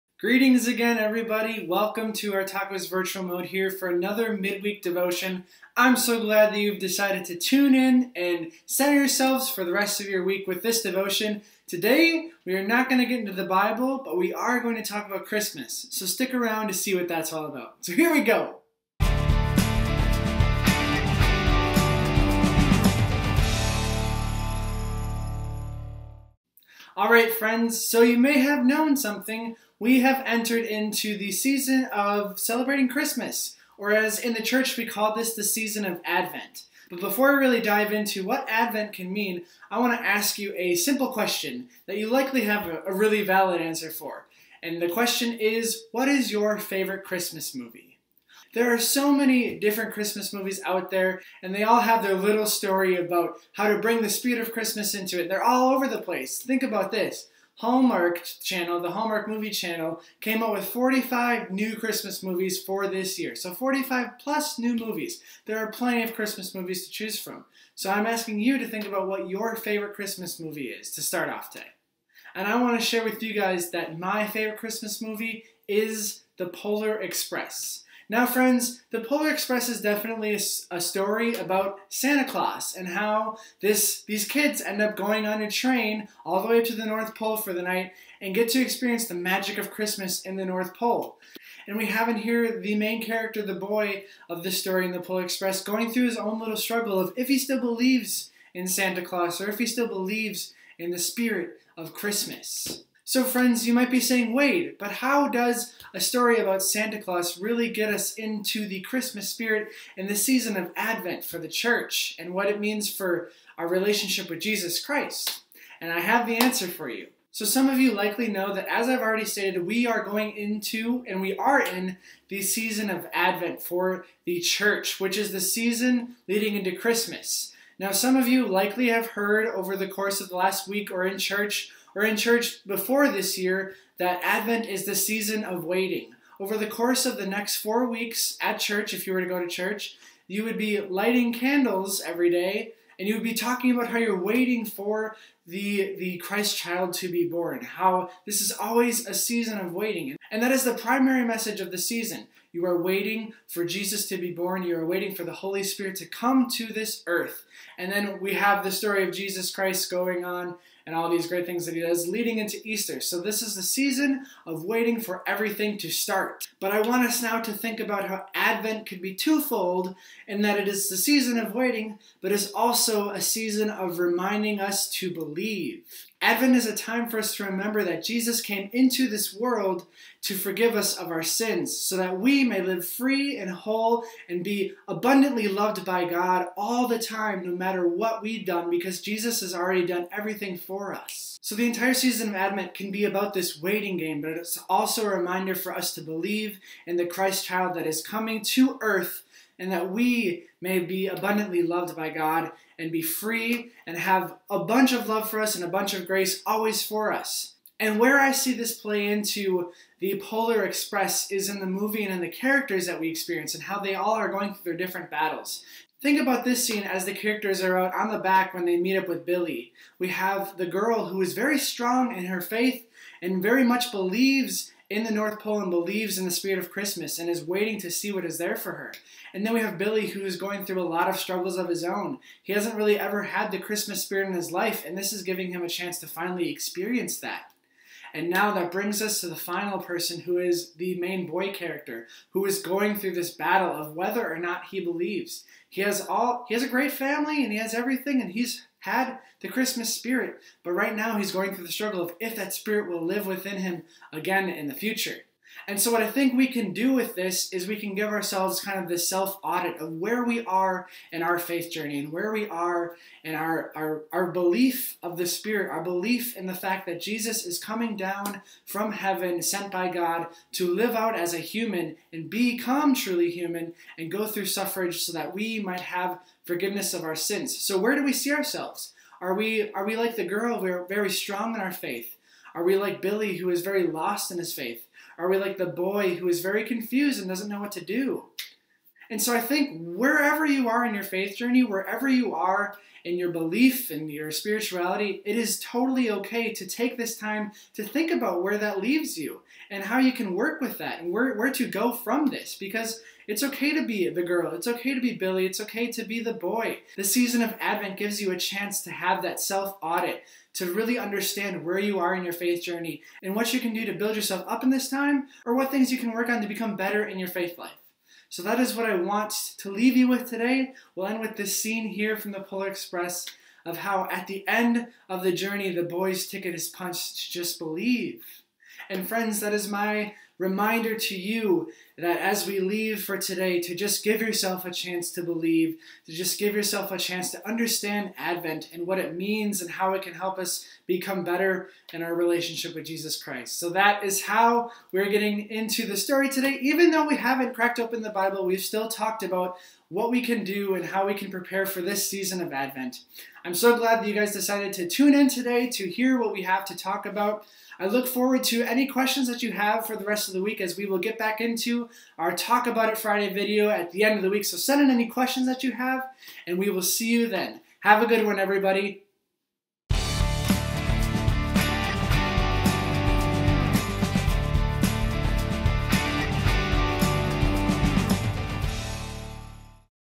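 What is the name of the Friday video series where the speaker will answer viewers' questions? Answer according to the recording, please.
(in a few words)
Talk About It Friday.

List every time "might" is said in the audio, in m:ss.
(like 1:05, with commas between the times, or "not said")
1:43, 4:35.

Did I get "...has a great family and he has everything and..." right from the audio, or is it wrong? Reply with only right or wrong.
right.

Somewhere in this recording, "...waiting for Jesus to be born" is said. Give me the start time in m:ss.
2:32.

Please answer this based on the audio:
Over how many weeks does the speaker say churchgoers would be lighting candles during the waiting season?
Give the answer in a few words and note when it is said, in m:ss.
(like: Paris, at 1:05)
4, at 2:17.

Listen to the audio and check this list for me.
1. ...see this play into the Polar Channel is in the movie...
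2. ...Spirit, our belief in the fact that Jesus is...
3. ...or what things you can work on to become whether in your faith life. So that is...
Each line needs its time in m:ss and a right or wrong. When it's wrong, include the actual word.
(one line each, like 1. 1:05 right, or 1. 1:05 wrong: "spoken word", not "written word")
1. 3:28 wrong: "Express", not "Channel"
2. 4:25 right
3. 5:15 wrong: "better", not "whether".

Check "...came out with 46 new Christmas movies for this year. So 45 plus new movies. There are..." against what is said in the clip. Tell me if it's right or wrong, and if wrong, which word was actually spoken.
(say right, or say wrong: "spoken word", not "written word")
wrong: "45", not "46".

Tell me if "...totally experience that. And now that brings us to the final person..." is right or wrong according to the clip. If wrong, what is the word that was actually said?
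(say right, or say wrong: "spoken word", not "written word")
wrong: "finally", not "totally".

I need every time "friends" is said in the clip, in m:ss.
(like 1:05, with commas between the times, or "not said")
0:27, 1:18, 1:43, 5:29.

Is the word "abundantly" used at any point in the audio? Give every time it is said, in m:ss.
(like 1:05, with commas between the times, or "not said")
3:04, 3:21.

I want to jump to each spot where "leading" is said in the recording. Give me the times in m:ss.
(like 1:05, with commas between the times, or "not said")
2:06, 2:42.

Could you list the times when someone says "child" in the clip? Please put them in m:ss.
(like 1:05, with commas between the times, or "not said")
2:26, 3:17.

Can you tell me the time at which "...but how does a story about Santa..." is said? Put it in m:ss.
1:44.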